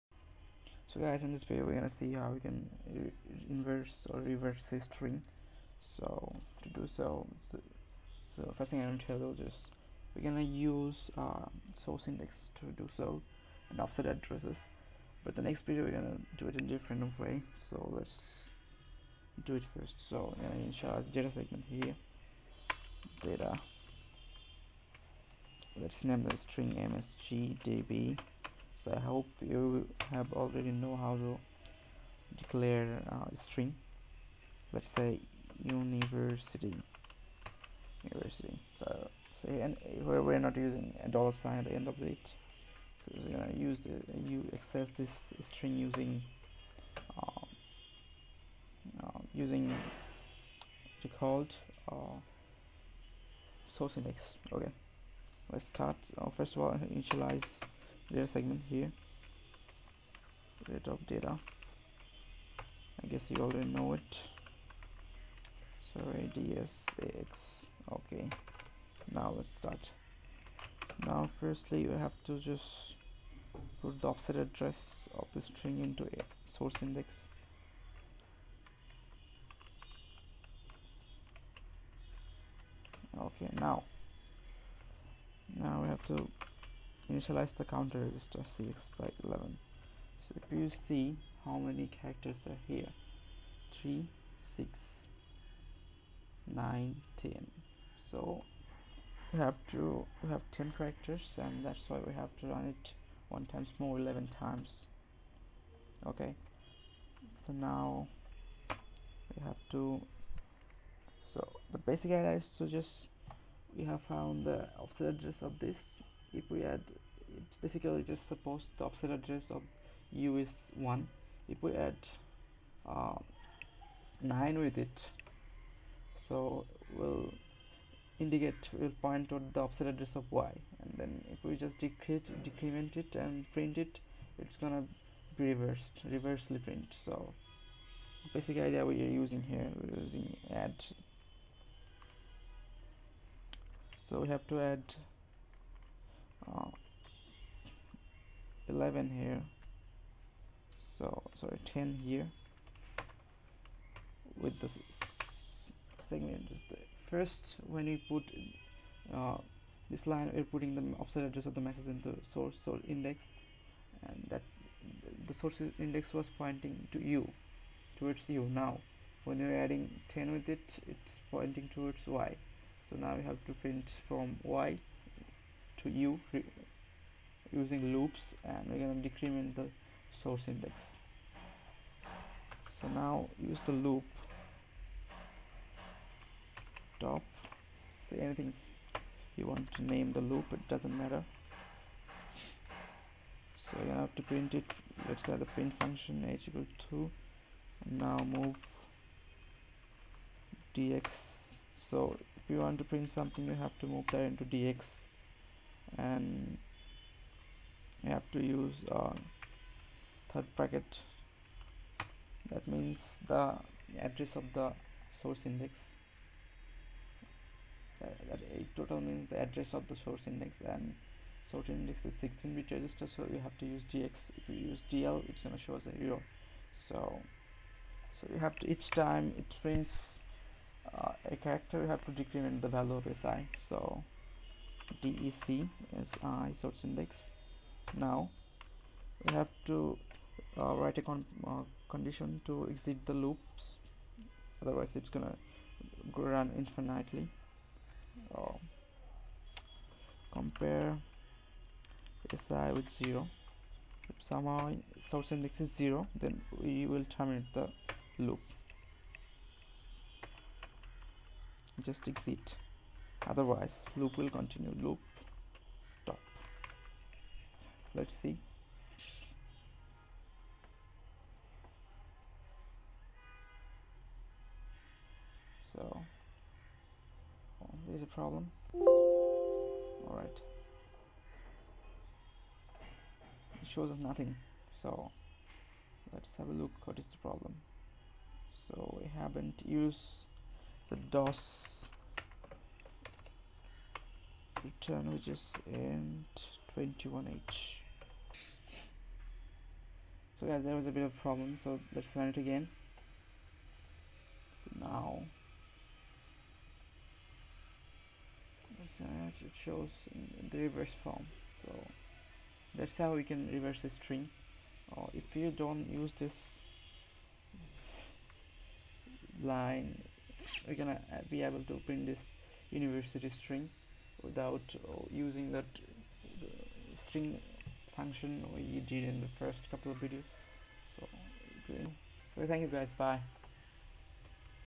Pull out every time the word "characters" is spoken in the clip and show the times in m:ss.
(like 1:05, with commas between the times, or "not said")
1:31, 1:40, 3:51.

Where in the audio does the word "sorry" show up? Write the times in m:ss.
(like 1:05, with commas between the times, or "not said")
1:05, 2:31.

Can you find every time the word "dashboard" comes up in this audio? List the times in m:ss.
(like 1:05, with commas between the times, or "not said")
not said.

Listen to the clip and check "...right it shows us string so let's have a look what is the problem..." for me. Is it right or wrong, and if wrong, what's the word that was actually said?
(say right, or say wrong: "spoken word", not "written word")
wrong: "nothing", not "string".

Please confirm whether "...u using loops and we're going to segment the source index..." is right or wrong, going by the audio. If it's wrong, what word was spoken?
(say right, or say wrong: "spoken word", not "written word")
wrong: "decrement", not "segment".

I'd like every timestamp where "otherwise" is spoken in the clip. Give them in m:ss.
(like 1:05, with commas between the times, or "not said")
4:04, 4:23.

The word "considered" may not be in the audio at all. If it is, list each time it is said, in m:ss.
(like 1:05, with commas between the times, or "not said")
not said.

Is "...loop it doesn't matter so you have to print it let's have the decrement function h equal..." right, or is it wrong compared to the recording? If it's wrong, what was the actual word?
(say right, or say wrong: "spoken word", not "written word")
wrong: "print", not "decrement".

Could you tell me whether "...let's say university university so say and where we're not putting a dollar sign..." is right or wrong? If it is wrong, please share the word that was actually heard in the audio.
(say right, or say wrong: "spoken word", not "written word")
wrong: "using", not "putting".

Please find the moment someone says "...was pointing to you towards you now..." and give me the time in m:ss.
2:46.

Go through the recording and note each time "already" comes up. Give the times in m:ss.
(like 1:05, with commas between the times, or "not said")
0:30, 1:03.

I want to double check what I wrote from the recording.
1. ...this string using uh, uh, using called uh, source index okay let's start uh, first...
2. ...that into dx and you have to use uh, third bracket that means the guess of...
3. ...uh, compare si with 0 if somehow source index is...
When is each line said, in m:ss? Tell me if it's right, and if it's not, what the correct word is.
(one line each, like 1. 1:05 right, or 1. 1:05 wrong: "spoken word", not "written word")
1. 0:44 right
2. 3:24 wrong: "address", not "guess"
3. 4:08 right.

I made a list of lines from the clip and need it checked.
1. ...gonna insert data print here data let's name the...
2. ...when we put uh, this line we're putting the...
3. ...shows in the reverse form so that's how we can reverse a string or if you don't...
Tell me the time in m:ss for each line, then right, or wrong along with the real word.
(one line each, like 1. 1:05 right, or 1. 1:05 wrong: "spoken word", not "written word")
1. 0:20 wrong: "segment", not "print"
2. 2:37 right
3. 5:09 right.